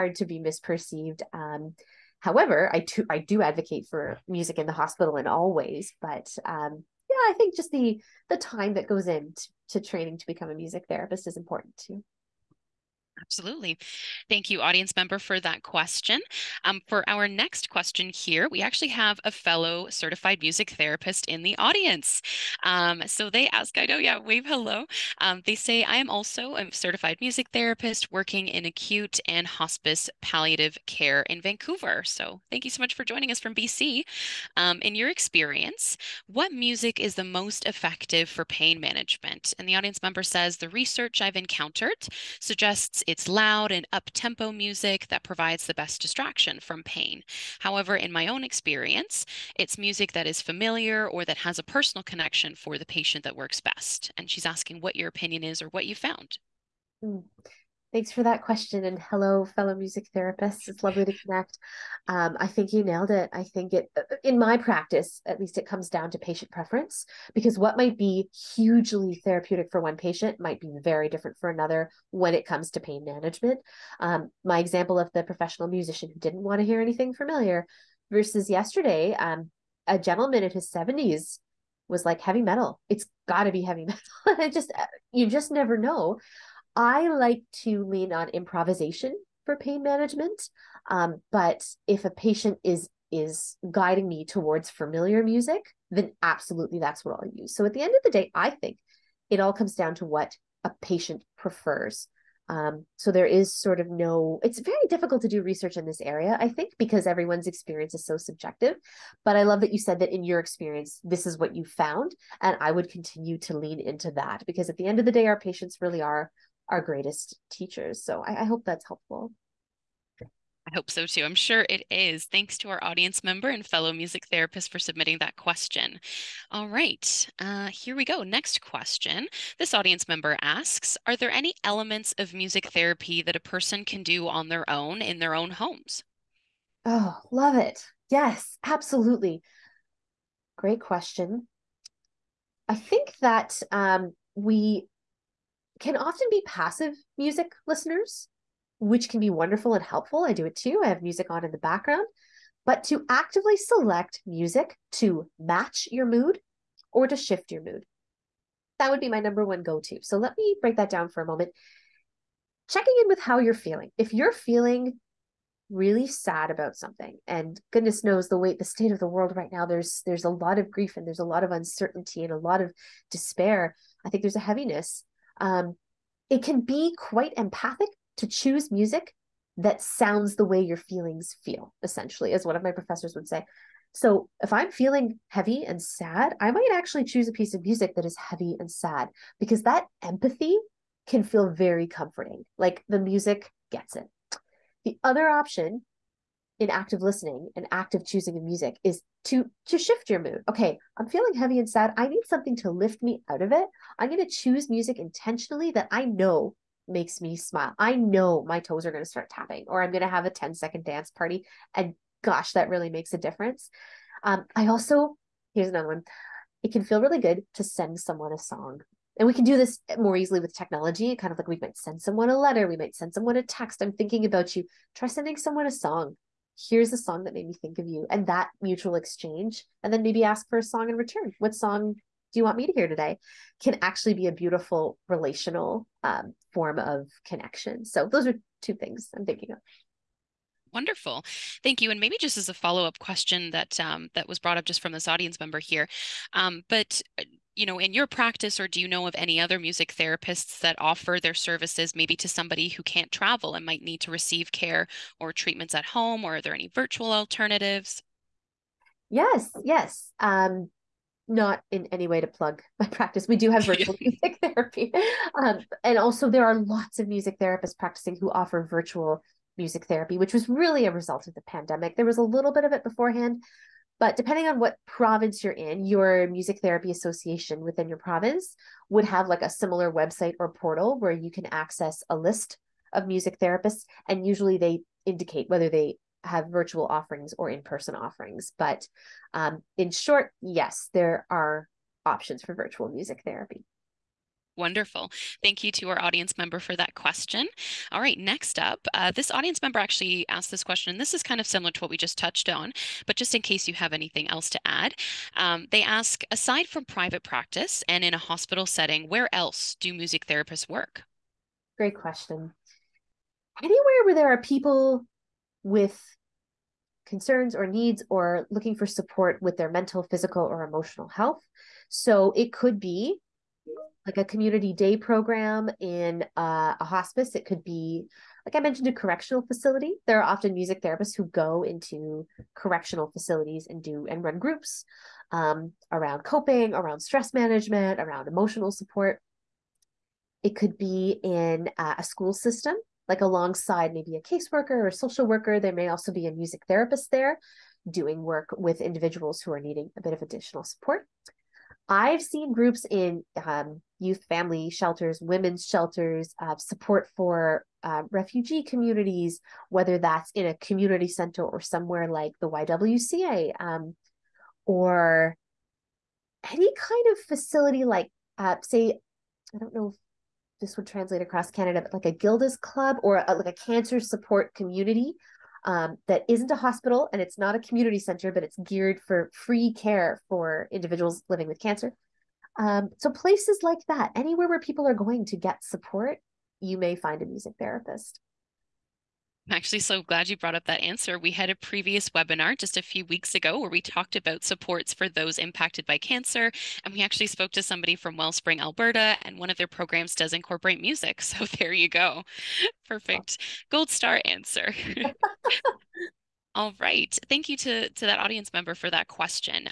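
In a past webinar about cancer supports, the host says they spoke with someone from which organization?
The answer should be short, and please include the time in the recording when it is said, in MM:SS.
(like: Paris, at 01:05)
Wellspring, Alberta, at 06:38.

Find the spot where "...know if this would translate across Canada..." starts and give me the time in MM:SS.
06:09.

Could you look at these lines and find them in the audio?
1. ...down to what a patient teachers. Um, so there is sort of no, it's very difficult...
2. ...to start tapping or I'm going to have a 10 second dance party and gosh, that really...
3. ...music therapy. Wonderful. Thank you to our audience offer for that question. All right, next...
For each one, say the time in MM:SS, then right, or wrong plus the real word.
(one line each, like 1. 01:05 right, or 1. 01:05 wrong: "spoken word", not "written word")
1. 01:39 wrong: "prefers", not "teachers"
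2. 03:29 right
3. 04:52 wrong: "member", not "offer".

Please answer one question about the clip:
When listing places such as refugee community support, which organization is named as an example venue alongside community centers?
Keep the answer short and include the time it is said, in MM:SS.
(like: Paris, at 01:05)
YWCA, at 06:02.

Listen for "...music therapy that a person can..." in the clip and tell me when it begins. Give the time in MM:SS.
02:12.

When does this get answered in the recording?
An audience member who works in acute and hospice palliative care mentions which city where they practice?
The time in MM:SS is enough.
00:31.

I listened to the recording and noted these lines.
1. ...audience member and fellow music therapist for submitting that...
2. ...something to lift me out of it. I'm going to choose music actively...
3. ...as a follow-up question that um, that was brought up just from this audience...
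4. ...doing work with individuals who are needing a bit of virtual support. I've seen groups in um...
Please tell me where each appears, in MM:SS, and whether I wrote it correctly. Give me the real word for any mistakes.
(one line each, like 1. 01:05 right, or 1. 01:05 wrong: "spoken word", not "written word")
1. 02:02 right
2. 03:22 wrong: "intentionally", not "actively"
3. 04:02 right
4. 05:47 wrong: "additional", not "virtual".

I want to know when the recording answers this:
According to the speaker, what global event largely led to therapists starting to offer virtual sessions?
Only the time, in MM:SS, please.
04:31.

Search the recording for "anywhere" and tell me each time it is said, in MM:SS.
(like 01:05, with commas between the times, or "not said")
05:13, 06:24.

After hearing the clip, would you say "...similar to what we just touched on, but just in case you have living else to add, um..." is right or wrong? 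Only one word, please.
wrong.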